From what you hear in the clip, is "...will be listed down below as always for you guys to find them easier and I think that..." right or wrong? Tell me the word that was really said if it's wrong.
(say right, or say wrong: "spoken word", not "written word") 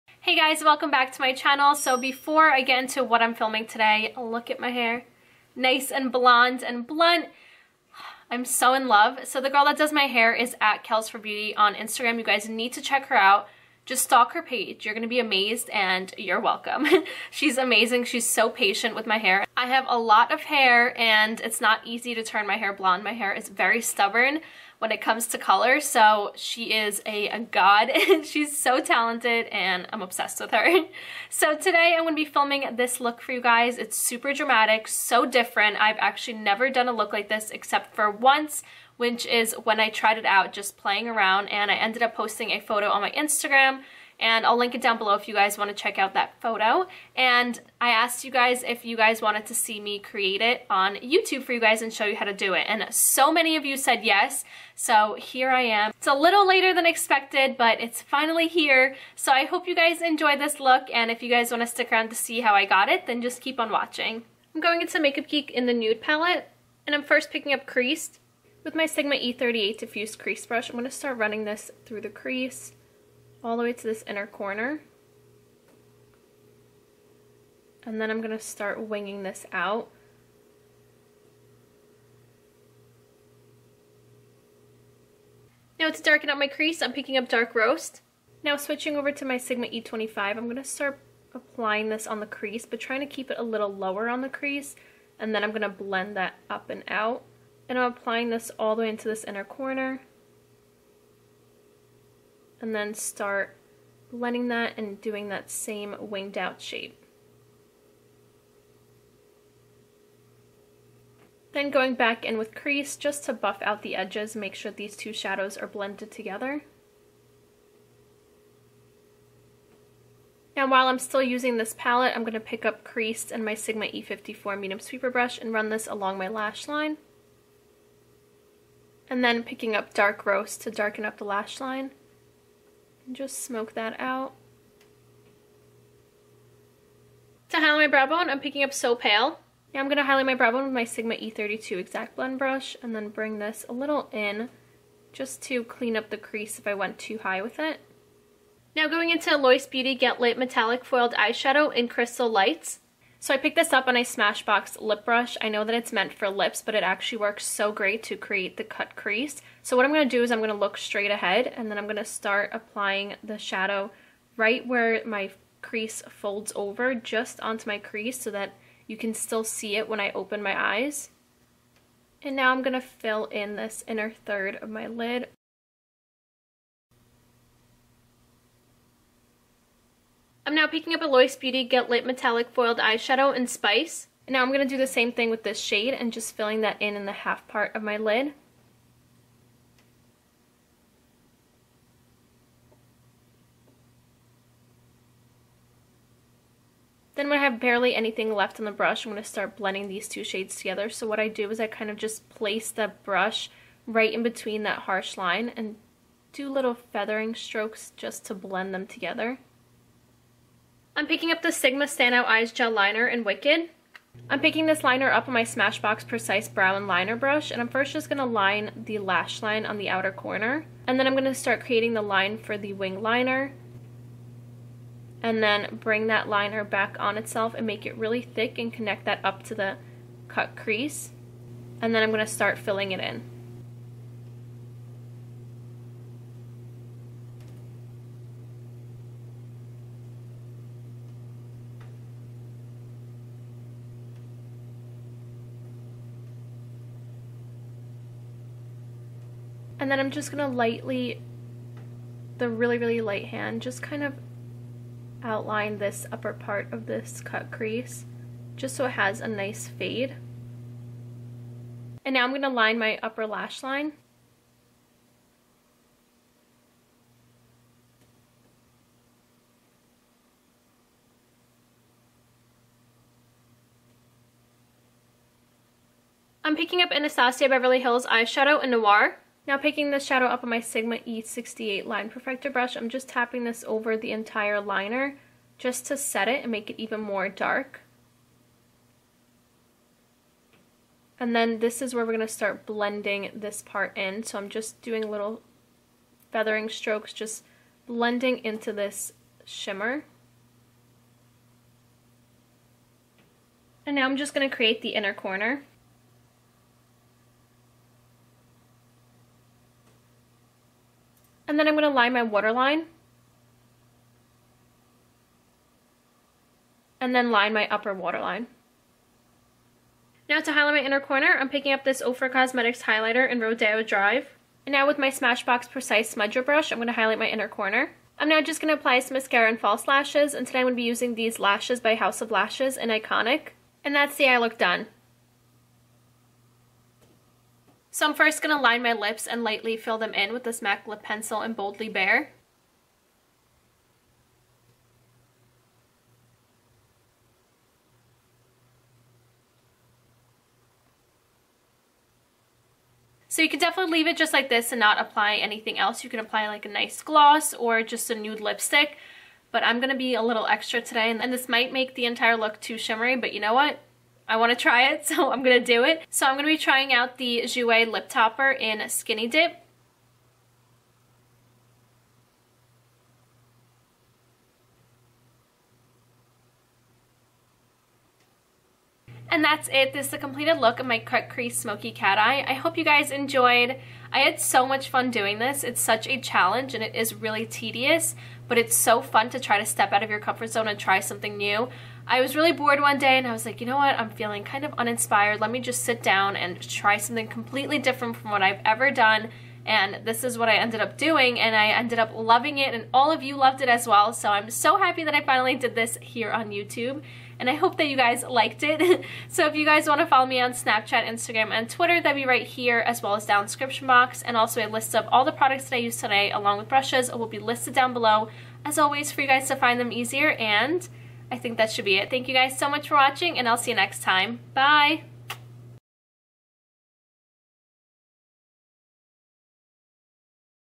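right.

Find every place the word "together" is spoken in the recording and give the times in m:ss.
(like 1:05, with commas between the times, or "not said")
1:56, 3:20, 3:28.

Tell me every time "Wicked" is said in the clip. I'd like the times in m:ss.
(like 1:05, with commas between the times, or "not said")
3:33.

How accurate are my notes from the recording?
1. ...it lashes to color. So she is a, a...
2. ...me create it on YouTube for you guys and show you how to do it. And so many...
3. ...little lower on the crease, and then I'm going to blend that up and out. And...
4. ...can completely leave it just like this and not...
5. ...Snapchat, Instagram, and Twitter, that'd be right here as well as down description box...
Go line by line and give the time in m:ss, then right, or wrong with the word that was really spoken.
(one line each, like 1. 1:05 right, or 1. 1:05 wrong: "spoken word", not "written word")
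1. 0:24 wrong: "comes", not "lashes"
2. 0:49 right
3. 1:33 right
4. 5:53 wrong: "definitely", not "completely"
5. 6:50 right.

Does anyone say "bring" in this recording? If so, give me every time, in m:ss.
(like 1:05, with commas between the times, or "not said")
2:23, 3:45.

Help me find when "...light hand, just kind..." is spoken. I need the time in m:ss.
4:13.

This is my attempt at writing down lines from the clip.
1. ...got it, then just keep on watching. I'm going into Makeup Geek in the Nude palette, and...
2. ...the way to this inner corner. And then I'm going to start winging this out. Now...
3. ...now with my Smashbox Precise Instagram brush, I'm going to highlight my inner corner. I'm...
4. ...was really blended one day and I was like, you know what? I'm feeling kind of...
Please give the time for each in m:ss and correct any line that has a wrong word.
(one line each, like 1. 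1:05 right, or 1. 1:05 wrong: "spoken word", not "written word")
1. 1:02 right
2. 1:13 right
3. 5:24 wrong: "Smudger", not "Instagram"
4. 6:32 wrong: "bored", not "blended".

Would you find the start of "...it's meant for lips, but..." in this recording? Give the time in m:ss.
2:35.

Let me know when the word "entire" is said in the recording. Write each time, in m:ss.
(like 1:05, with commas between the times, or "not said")
4:44, 6:02.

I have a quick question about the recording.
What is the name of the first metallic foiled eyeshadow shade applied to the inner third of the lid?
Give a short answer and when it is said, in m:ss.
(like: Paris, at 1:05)
Crystal Lights, at 2:31.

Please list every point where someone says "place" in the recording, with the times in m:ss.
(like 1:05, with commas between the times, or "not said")
3:22.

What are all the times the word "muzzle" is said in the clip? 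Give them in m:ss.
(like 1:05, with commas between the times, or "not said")
not said.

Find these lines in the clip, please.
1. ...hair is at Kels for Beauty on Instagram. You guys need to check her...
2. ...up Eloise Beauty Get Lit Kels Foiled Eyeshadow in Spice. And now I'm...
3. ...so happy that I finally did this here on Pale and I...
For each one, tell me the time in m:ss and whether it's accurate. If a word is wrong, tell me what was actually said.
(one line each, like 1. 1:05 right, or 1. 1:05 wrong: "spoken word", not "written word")
1. 0:10 right
2. 3:00 wrong: "Metallic", not "Kels"
3. 6:44 wrong: "YouTube", not "Pale".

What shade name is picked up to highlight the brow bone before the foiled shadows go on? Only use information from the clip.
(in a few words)
So Pale.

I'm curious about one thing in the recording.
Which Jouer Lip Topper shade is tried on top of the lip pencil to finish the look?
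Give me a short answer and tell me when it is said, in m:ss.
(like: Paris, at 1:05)
Skinny Dip, at 6:08.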